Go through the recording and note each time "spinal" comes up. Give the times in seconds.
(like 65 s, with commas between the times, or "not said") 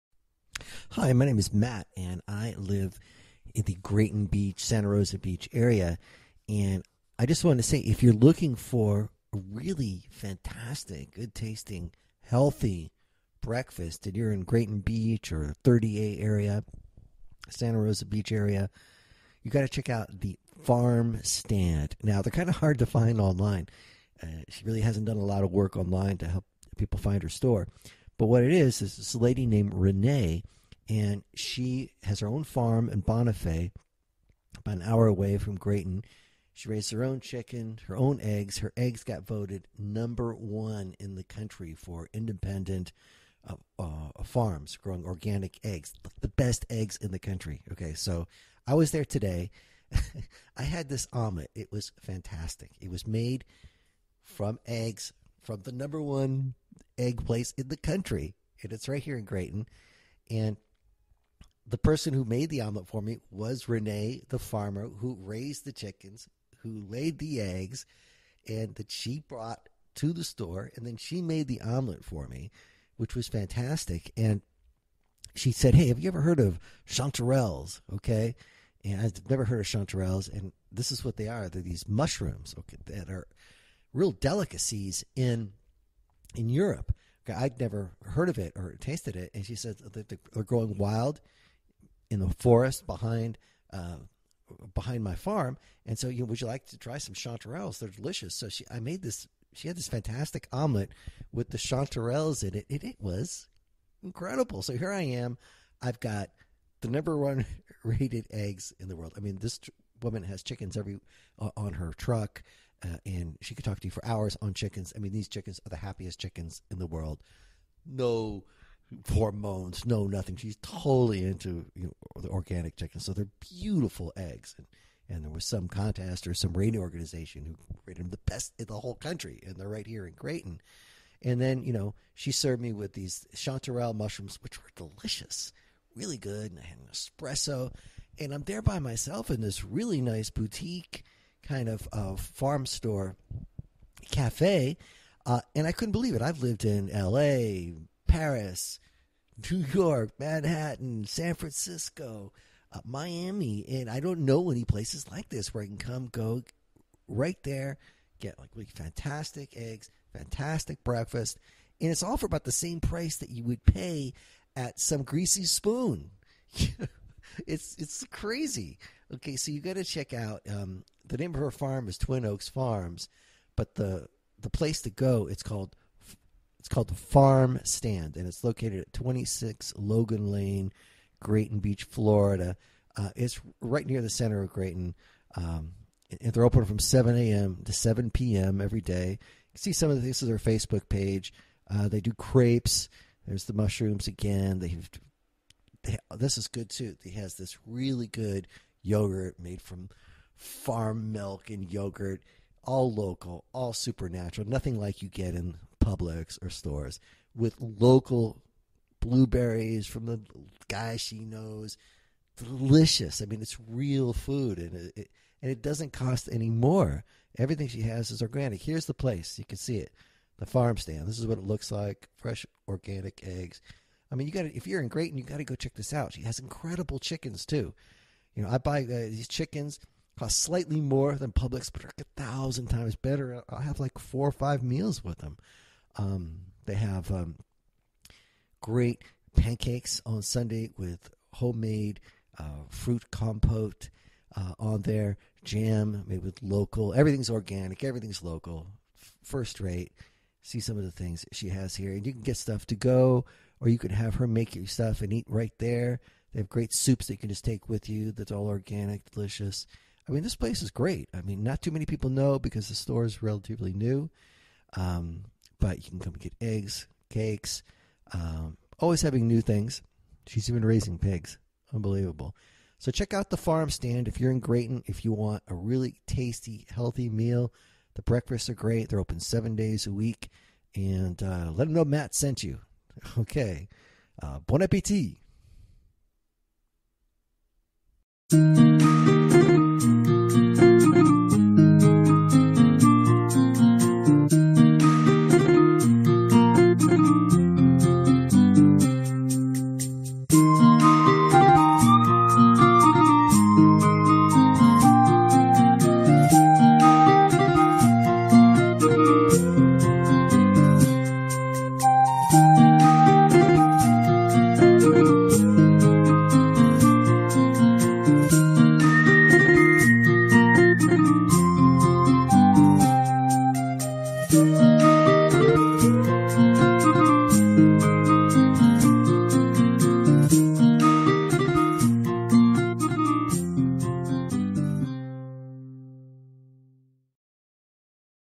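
not said.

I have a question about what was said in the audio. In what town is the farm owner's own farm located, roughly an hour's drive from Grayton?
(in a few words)
Bonifay.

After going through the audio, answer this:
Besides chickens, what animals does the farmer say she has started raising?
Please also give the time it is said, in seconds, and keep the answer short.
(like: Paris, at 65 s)
Pigs, at 270 s.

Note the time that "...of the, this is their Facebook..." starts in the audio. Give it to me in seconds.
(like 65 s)
189 s.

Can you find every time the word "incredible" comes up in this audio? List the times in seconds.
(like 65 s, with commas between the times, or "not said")
104 s, 226 s.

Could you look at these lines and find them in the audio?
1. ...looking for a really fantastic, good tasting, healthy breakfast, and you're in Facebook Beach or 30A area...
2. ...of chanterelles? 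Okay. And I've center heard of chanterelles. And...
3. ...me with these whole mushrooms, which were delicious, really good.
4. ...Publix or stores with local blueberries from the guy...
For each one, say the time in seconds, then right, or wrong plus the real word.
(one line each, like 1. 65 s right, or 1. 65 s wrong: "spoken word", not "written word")
1. 8 s wrong: "Grayton", not "Facebook"
2. 76 s wrong: "never", not "center"
3. 132 s wrong: "chanterelle", not "whole"
4. 205 s right.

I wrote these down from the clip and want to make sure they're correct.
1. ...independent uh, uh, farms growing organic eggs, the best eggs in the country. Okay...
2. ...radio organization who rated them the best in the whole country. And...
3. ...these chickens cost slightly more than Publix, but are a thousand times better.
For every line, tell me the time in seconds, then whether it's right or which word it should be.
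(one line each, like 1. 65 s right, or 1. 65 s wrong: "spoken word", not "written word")
1. 42 s right
2. 126 s right
3. 228 s right.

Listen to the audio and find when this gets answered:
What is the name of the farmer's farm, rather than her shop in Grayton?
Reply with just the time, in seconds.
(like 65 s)
171 s.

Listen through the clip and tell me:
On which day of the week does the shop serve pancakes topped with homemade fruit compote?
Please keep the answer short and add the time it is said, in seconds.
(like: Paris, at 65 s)
Sunday, at 240 s.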